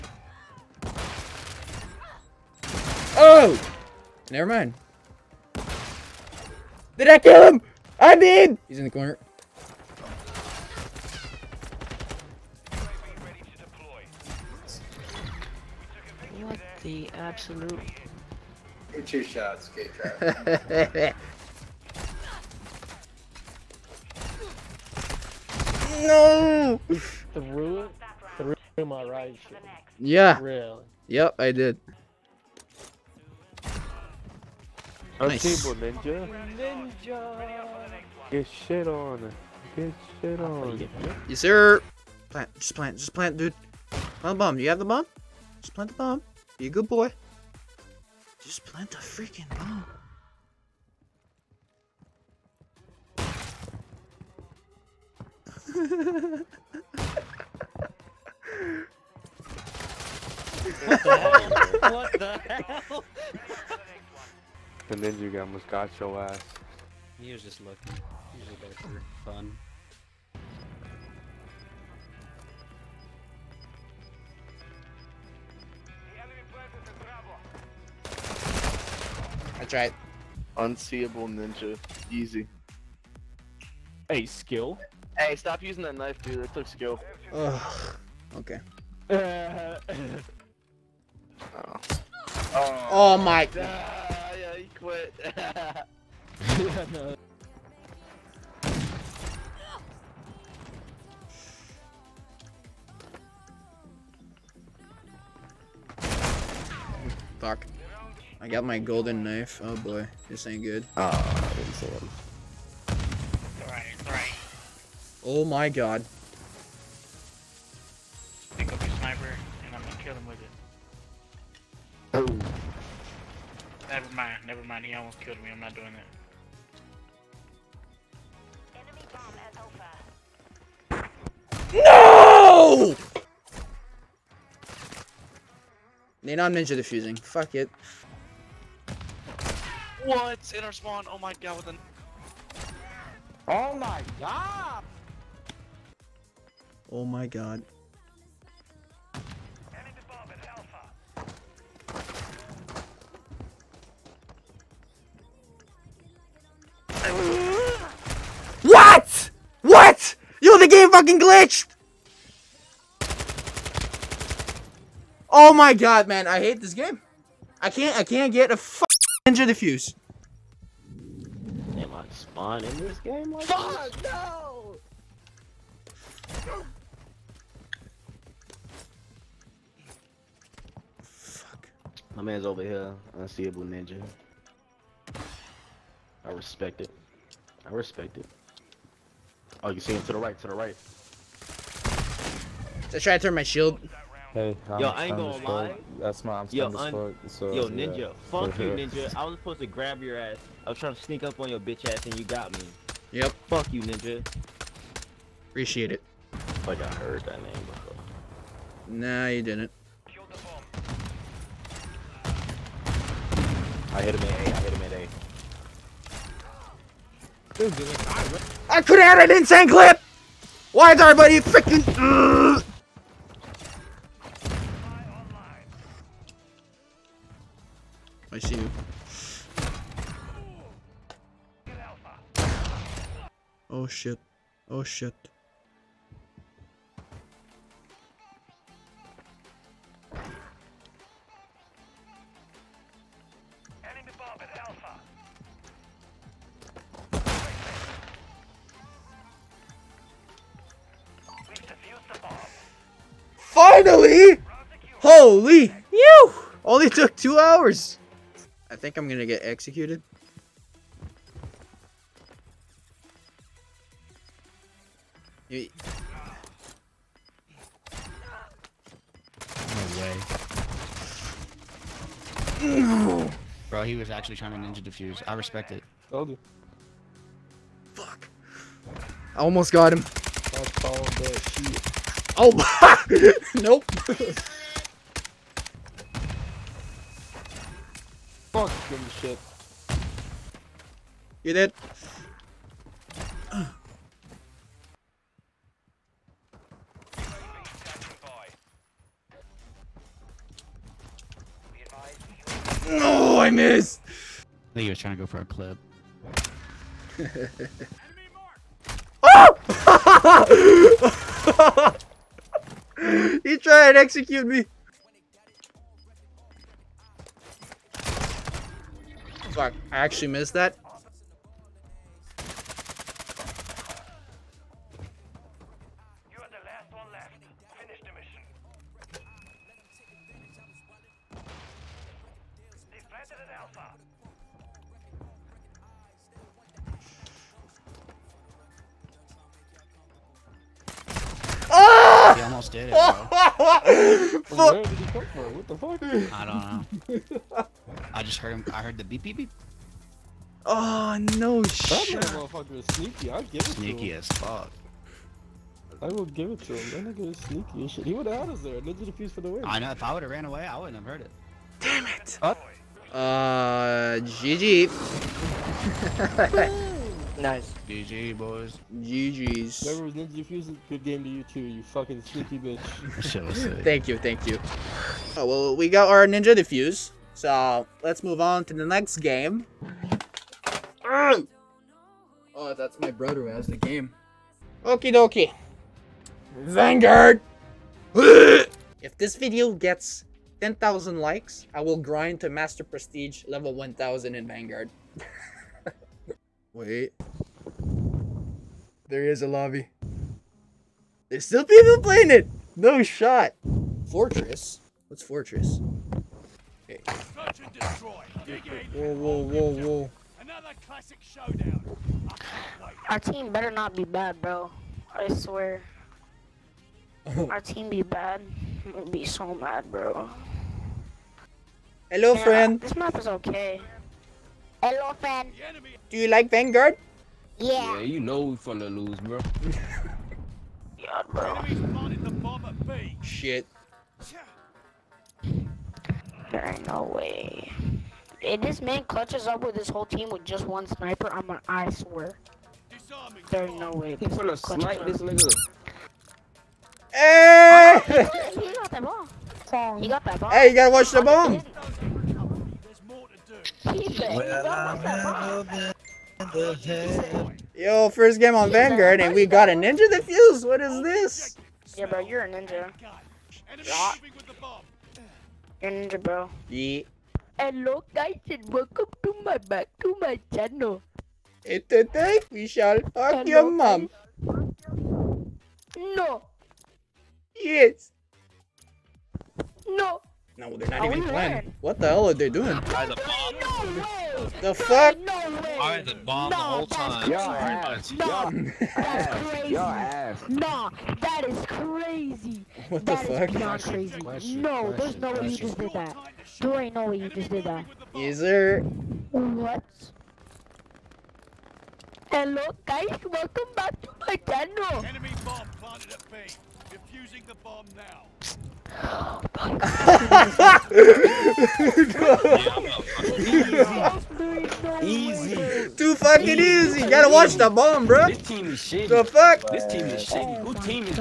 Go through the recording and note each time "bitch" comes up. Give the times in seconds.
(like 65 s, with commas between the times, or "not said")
201 s, 372 s.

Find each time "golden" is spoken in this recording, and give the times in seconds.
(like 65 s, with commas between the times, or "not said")
108 s.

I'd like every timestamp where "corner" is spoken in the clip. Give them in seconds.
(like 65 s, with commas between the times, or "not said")
8 s.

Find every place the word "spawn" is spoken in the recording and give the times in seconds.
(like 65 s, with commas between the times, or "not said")
140 s, 172 s.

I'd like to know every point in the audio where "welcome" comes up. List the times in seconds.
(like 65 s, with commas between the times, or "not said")
468 s, 503 s.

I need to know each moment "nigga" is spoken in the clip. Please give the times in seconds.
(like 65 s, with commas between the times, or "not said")
357 s, 445 s.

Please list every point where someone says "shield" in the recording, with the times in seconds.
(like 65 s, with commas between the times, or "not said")
193 s.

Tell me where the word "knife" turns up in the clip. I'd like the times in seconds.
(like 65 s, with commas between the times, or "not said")
85 s, 109 s.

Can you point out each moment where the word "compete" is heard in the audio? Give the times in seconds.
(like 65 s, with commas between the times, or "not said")
not said.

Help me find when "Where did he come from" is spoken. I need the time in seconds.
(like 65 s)
344 s.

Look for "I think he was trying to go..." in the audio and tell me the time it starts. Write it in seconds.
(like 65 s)
304 s.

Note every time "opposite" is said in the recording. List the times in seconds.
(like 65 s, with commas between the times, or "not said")
not said.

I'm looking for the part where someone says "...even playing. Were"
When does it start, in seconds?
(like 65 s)
481 s.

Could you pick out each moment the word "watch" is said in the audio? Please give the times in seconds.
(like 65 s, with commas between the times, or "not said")
450 s, 517 s.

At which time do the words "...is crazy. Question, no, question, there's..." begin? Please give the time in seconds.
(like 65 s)
493 s.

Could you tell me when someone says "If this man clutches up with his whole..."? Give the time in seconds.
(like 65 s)
438 s.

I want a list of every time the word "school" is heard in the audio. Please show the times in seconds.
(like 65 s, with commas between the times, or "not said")
not said.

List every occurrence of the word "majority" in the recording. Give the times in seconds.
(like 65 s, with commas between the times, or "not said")
not said.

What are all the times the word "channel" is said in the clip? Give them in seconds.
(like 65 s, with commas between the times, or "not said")
470 s, 504 s.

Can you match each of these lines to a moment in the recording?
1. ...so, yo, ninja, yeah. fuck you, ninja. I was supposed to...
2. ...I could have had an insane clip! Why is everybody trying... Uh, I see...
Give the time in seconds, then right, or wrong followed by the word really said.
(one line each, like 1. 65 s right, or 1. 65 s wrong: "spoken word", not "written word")
1. 197 s right
2. 217 s wrong: "freaking", not "trying".